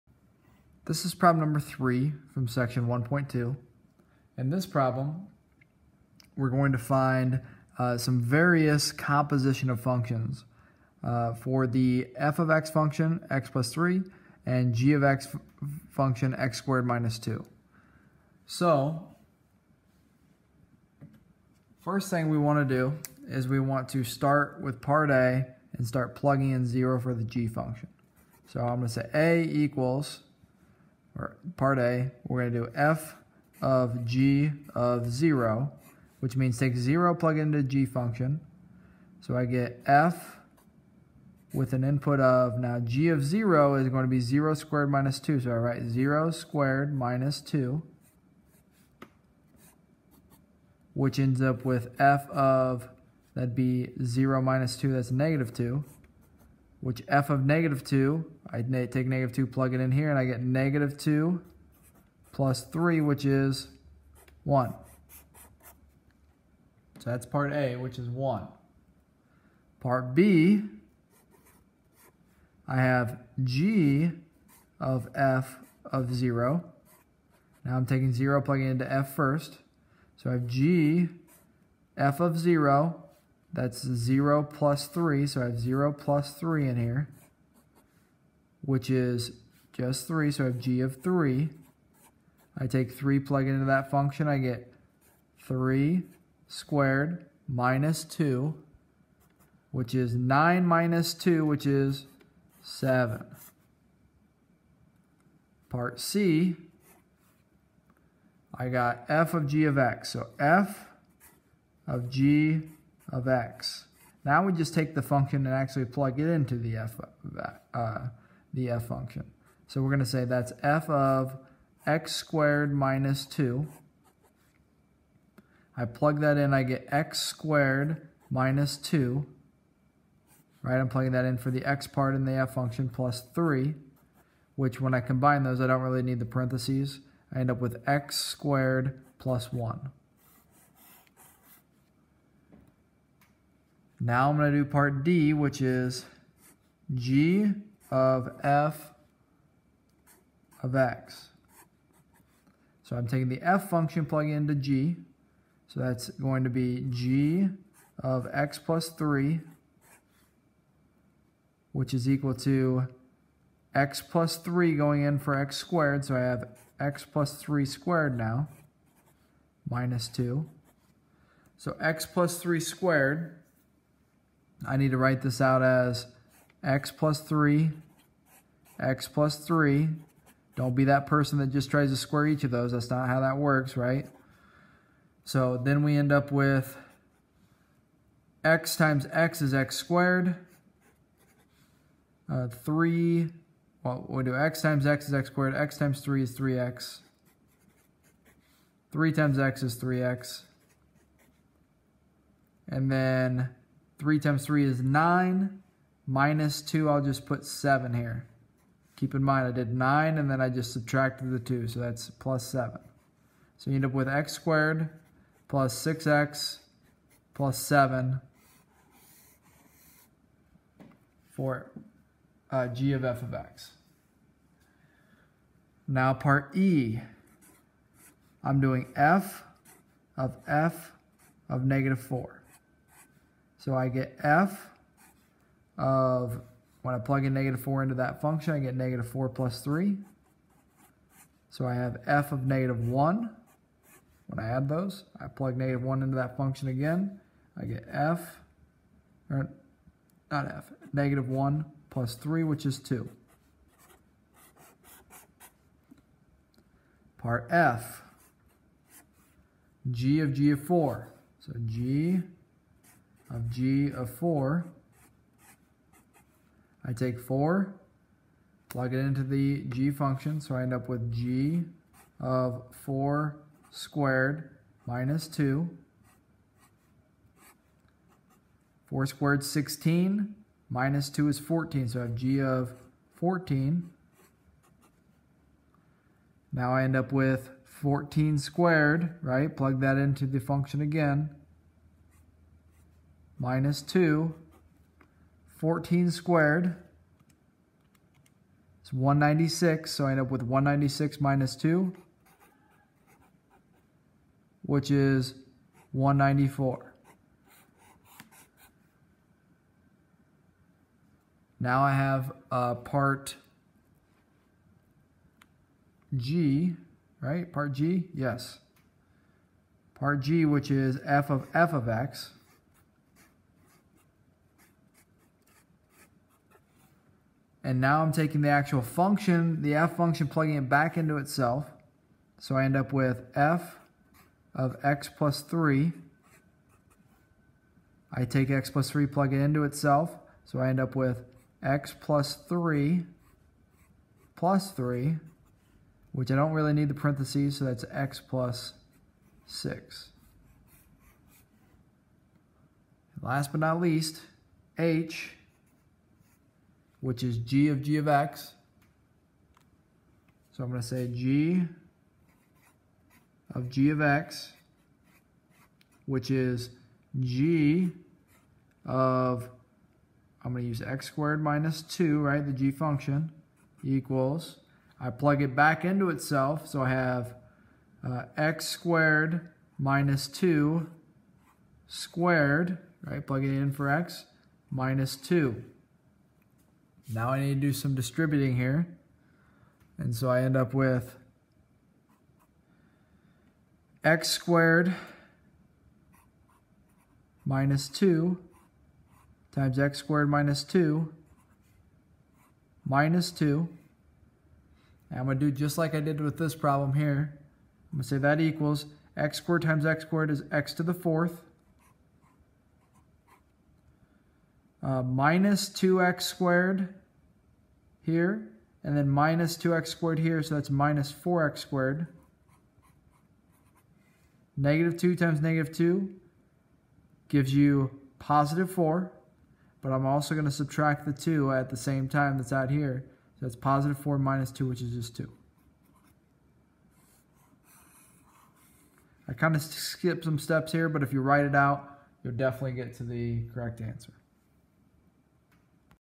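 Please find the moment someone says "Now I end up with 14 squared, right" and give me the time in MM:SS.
04:46.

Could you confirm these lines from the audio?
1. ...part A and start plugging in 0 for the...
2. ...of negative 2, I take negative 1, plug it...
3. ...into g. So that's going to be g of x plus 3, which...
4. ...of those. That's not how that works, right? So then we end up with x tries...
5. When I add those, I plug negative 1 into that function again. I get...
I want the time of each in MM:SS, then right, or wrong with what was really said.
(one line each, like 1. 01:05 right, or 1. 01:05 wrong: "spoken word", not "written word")
1. 00:24 right
2. 00:57 wrong: "2", not "1"
3. 02:34 right
4. 03:02 wrong: "times", not "tries"
5. 04:04 right.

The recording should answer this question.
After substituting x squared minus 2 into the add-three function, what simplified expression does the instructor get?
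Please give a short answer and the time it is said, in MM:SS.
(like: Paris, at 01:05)
x squared plus 1, at 02:17.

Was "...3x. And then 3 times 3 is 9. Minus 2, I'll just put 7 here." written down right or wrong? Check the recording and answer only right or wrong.
right.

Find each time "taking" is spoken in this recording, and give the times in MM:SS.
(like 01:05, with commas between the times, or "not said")
01:17, 02:33, 05:28.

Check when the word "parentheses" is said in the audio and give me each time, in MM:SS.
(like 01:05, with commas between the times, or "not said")
02:16, 05:46.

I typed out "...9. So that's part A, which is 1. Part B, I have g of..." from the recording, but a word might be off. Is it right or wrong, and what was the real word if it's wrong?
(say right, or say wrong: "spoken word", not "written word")
wrong: "1", not "9".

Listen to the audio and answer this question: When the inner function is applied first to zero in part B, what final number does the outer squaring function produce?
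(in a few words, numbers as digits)
7.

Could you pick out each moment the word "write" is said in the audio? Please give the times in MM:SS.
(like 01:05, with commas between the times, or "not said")
00:45, 02:54, 07:21.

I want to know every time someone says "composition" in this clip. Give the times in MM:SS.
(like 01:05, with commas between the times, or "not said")
00:08.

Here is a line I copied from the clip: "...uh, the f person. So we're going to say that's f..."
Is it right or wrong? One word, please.
wrong.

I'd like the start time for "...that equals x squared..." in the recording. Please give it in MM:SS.
06:48.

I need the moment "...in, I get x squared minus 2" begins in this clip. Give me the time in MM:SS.
02:06.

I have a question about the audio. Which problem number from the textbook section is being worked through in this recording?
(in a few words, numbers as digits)
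3.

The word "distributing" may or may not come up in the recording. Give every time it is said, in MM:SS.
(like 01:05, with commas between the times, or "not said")
06:27.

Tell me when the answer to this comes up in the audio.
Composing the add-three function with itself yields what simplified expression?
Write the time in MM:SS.
05:47.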